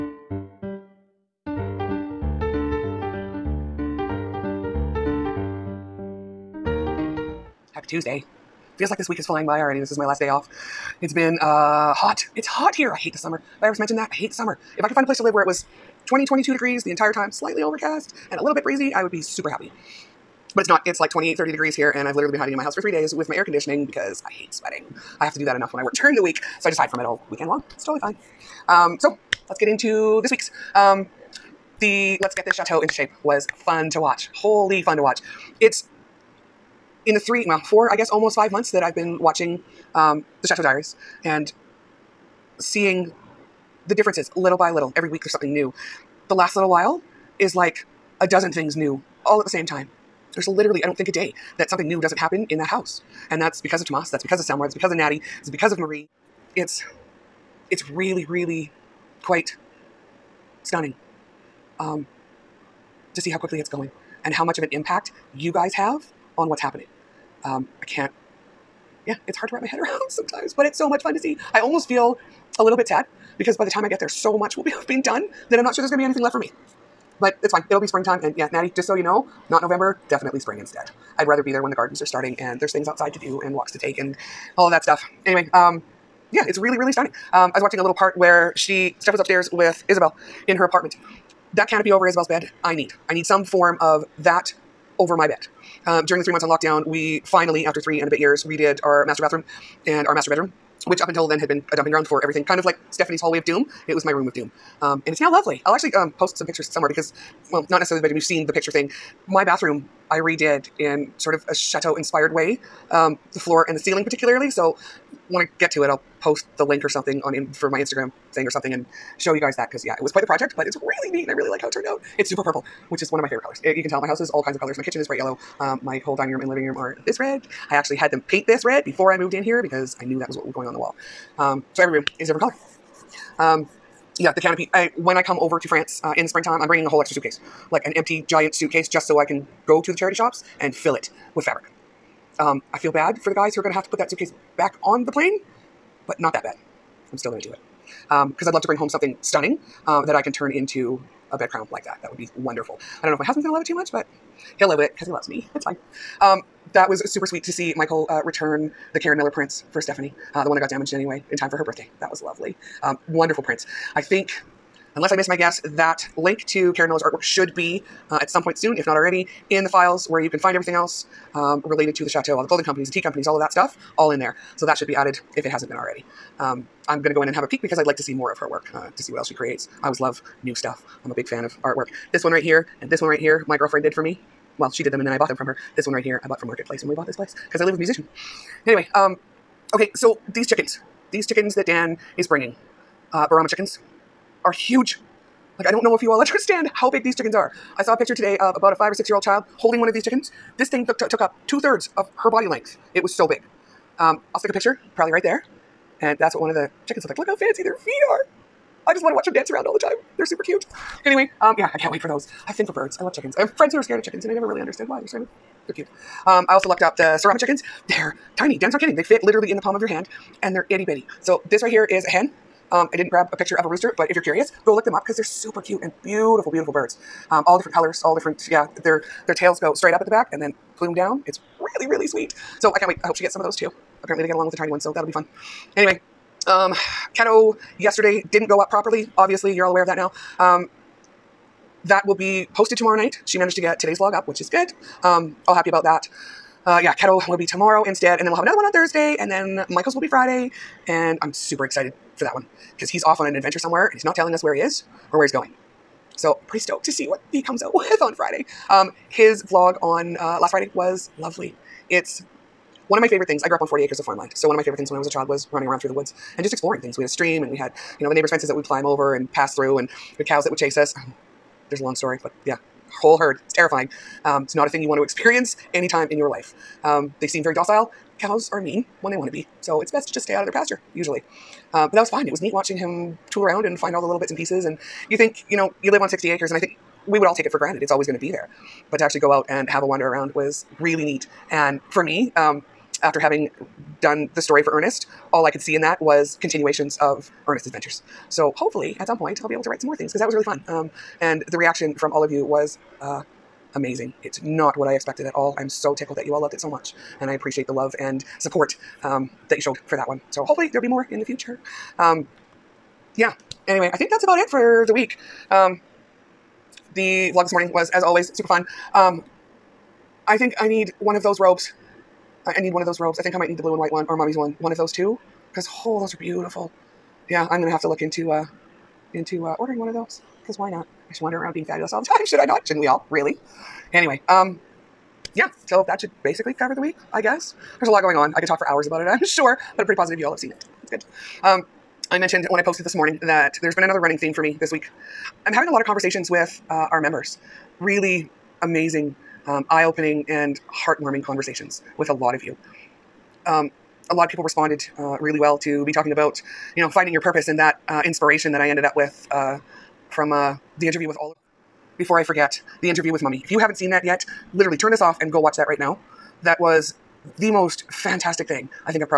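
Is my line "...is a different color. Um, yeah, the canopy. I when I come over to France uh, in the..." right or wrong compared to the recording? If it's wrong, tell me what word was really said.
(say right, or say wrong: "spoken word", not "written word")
right.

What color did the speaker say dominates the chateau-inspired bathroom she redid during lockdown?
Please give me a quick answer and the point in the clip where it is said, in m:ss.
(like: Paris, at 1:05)
Purple, at 2:02.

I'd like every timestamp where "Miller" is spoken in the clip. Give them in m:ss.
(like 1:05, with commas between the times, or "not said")
2:39, 2:46.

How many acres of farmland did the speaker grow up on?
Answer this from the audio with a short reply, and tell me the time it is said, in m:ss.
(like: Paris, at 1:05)
40, at 4:23.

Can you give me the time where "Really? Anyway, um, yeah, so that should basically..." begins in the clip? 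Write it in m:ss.
5:33.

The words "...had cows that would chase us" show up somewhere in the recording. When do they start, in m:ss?
4:30.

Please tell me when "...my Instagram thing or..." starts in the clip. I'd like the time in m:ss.
1:57.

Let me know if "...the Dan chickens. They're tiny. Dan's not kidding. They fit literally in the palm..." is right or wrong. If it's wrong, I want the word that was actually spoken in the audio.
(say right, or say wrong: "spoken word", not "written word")
wrong: "Serama", not "Dan".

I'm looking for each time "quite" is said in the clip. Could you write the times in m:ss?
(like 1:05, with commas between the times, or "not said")
0:59, 2:00.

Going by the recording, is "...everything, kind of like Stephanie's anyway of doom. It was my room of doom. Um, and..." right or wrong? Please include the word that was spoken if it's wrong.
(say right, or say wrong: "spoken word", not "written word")
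wrong: "hallway", not "anyway".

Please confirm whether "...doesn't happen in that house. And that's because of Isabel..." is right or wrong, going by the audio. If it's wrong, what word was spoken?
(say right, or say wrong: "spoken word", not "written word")
wrong: "Tomas", not "Isabel".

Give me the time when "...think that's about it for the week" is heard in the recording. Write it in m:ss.
5:13.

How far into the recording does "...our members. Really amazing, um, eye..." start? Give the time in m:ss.
5:46.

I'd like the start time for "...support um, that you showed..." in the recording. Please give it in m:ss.
5:08.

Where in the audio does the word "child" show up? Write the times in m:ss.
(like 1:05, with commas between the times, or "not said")
3:19, 4:25.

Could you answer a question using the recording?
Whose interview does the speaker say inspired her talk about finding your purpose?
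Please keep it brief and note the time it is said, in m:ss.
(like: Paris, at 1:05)
Oliver, at 6:01.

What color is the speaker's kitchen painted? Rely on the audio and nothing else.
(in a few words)
Bright yellow.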